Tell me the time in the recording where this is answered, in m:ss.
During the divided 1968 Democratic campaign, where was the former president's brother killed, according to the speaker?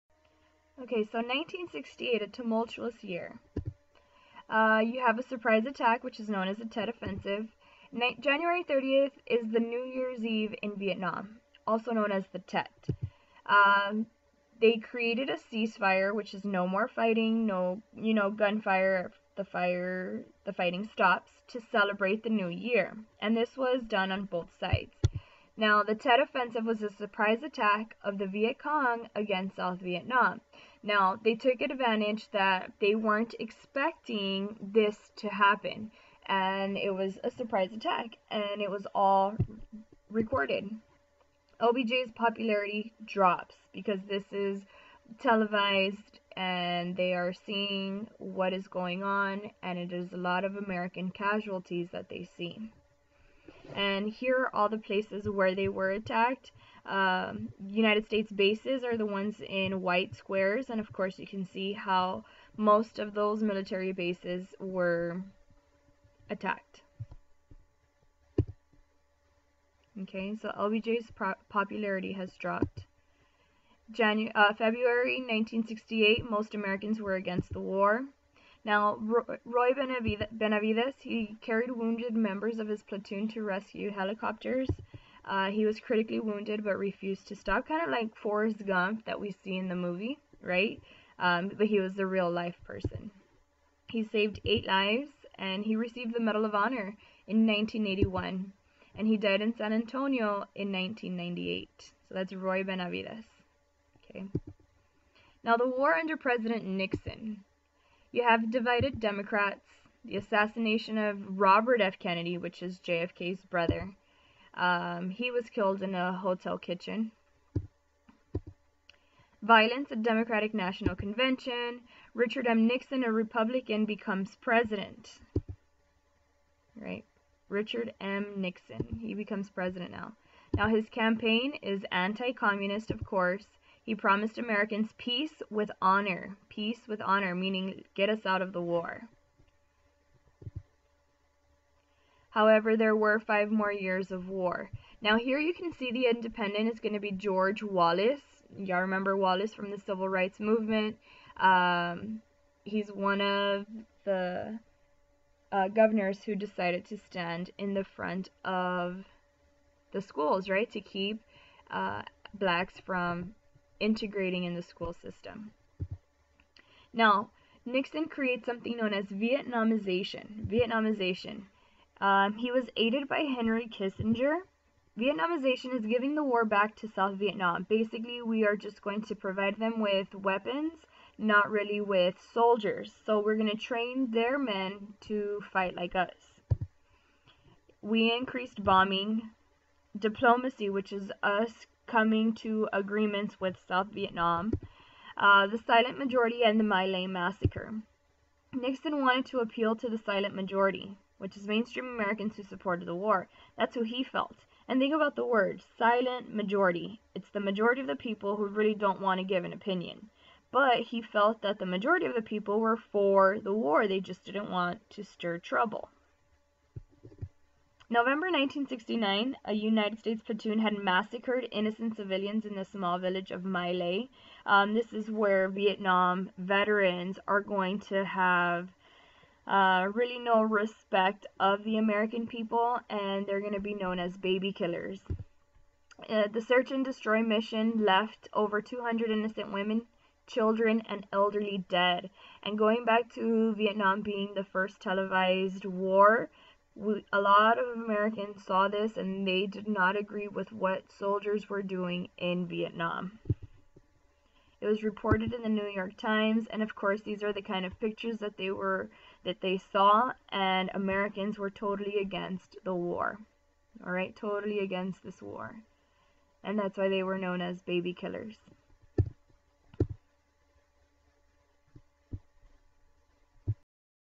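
1:56.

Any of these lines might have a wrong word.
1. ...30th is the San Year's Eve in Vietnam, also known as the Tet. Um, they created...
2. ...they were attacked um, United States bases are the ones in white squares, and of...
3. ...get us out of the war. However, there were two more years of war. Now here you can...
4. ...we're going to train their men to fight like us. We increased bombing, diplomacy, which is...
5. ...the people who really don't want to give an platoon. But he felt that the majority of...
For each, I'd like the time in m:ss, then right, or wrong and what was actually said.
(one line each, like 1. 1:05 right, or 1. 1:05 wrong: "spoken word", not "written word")
1. 0:08 wrong: "New", not "San"
2. 0:55 right
3. 2:17 wrong: "five", not "two"
4. 3:03 right
5. 3:27 wrong: "opinion", not "platoon".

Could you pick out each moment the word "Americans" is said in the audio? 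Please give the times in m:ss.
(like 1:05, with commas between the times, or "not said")
0:50, 1:16, 2:14, 3:21, 3:51, 4:07, 4:20.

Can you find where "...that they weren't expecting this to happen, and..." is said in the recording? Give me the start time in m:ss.
0:32.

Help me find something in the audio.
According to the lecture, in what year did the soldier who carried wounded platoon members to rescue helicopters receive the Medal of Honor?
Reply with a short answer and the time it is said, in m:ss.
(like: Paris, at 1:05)
1981, at 1:37.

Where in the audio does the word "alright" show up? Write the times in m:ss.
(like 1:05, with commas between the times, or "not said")
not said.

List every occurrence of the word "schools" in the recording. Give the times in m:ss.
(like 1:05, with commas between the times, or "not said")
2:40, 2:44.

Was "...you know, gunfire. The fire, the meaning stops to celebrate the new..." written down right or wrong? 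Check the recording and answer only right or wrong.
wrong.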